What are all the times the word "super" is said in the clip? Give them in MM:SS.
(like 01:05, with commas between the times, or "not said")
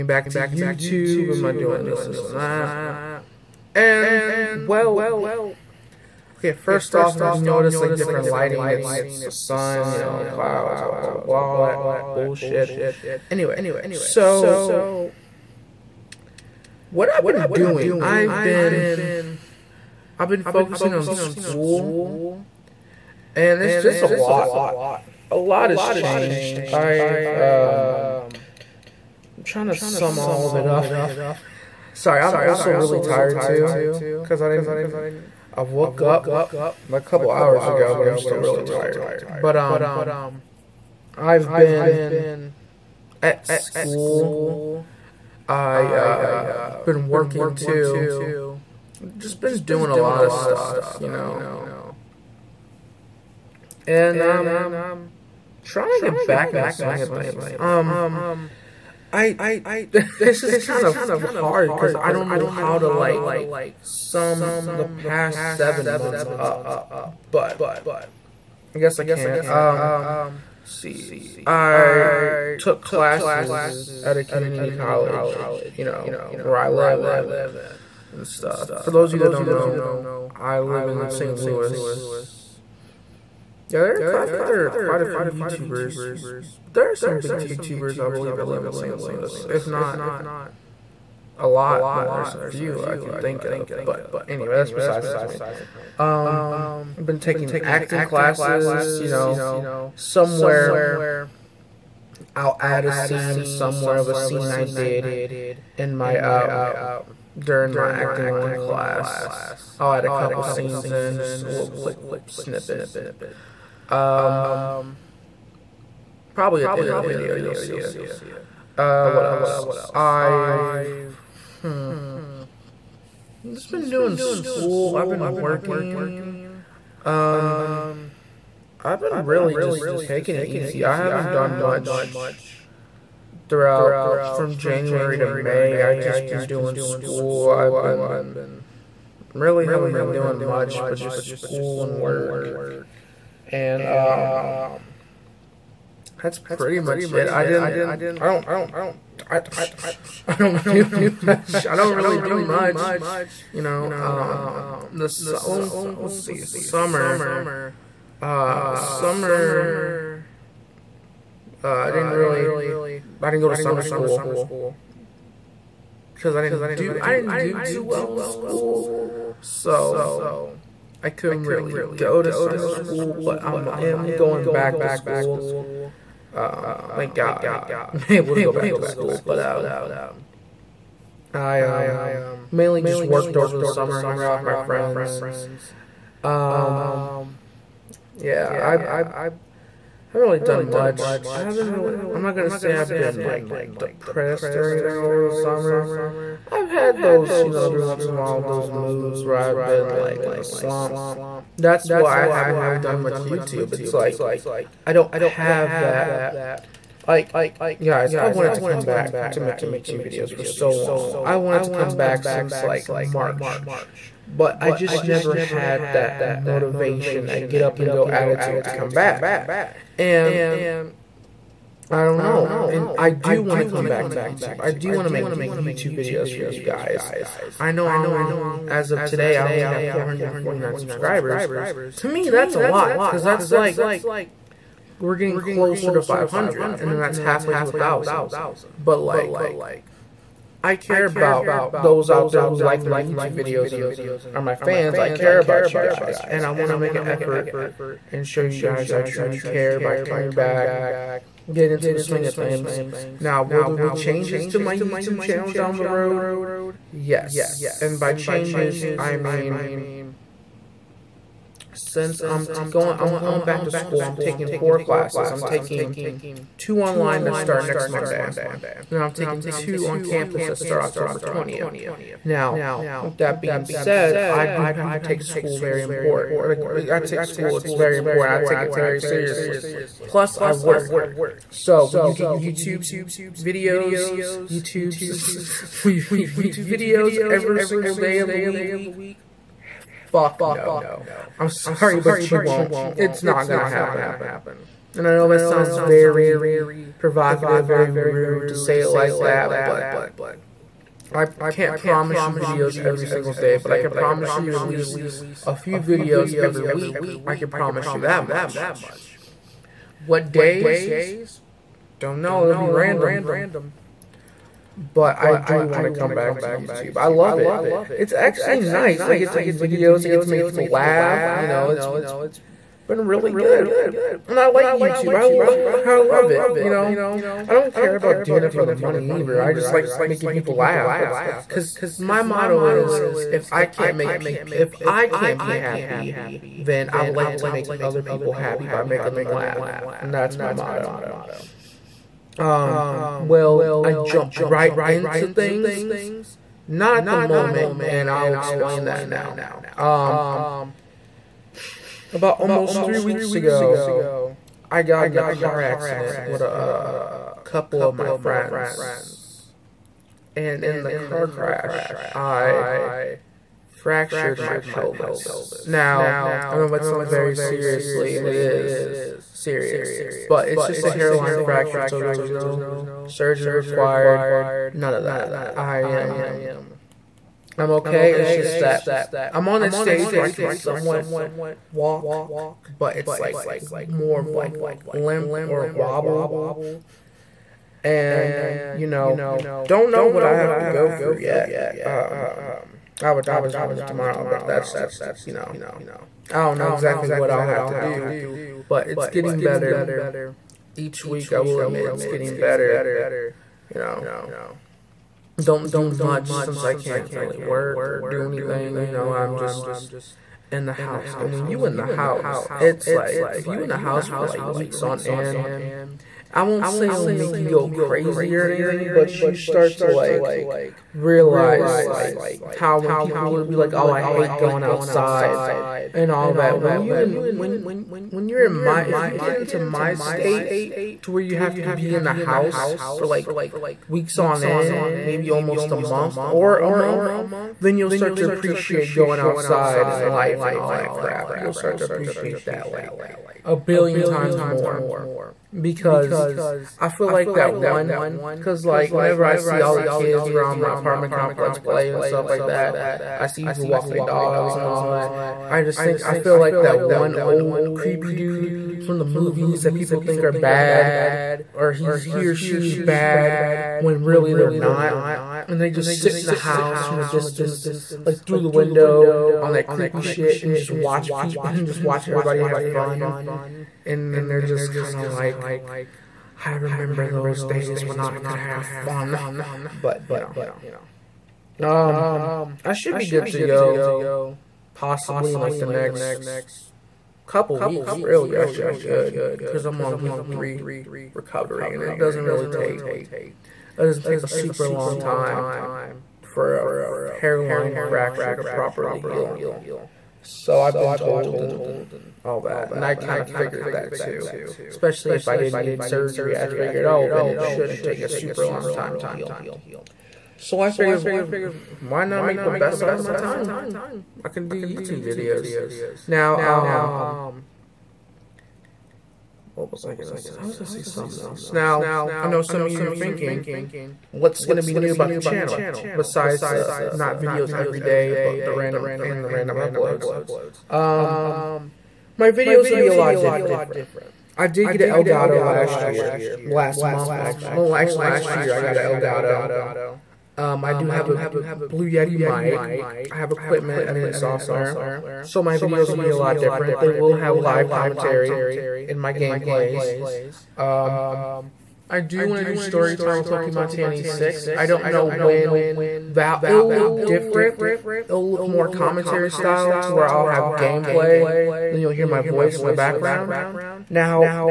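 08:14, 08:28.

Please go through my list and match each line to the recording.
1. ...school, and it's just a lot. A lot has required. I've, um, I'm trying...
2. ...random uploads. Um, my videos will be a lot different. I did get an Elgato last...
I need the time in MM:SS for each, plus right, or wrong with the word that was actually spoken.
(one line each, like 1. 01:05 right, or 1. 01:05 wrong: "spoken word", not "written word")
1. 00:21 wrong: "changed", not "required"
2. 08:49 right.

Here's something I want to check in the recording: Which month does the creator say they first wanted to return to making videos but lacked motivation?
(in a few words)
March.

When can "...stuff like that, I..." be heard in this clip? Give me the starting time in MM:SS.
07:32.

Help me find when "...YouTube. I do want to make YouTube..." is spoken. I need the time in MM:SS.
03:44.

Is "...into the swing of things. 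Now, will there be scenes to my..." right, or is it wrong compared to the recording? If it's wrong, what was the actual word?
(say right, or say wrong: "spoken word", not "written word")
wrong: "changes", not "scenes".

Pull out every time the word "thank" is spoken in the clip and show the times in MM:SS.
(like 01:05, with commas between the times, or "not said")
02:56.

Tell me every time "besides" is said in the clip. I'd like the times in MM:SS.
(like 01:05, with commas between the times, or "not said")
01:34, 08:45.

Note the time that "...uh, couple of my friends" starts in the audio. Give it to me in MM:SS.
05:56.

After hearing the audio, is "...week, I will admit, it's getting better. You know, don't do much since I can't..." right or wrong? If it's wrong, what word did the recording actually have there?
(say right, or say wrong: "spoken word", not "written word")
right.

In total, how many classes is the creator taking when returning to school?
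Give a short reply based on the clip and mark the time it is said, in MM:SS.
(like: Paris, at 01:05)
4, at 04:24.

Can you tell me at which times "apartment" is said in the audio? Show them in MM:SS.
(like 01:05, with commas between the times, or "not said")
07:30.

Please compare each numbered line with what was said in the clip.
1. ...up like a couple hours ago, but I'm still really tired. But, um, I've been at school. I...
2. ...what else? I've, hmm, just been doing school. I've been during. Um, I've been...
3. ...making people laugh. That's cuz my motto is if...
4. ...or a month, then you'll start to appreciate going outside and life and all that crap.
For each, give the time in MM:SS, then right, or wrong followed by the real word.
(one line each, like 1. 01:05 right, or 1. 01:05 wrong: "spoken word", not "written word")
1. 00:35 right
2. 01:59 wrong: "working", not "during"
3. 05:30 right
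4. 07:16 right.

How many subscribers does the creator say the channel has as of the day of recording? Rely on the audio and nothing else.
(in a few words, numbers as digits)
449.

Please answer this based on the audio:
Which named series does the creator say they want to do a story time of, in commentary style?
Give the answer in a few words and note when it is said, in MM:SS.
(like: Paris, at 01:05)
Pokemon1086, at 09:13.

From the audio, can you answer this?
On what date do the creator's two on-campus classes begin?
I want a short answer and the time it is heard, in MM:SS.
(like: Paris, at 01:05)
October 20th, at 04:30.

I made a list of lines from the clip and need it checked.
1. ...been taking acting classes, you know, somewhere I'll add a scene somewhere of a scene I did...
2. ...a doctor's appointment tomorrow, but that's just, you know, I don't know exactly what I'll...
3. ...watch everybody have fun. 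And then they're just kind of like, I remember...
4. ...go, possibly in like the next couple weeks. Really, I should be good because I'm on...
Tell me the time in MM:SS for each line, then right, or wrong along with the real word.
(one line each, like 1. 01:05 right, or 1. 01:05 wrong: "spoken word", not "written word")
1. 01:37 right
2. 06:33 right
3. 07:51 right
4. 08:03 right.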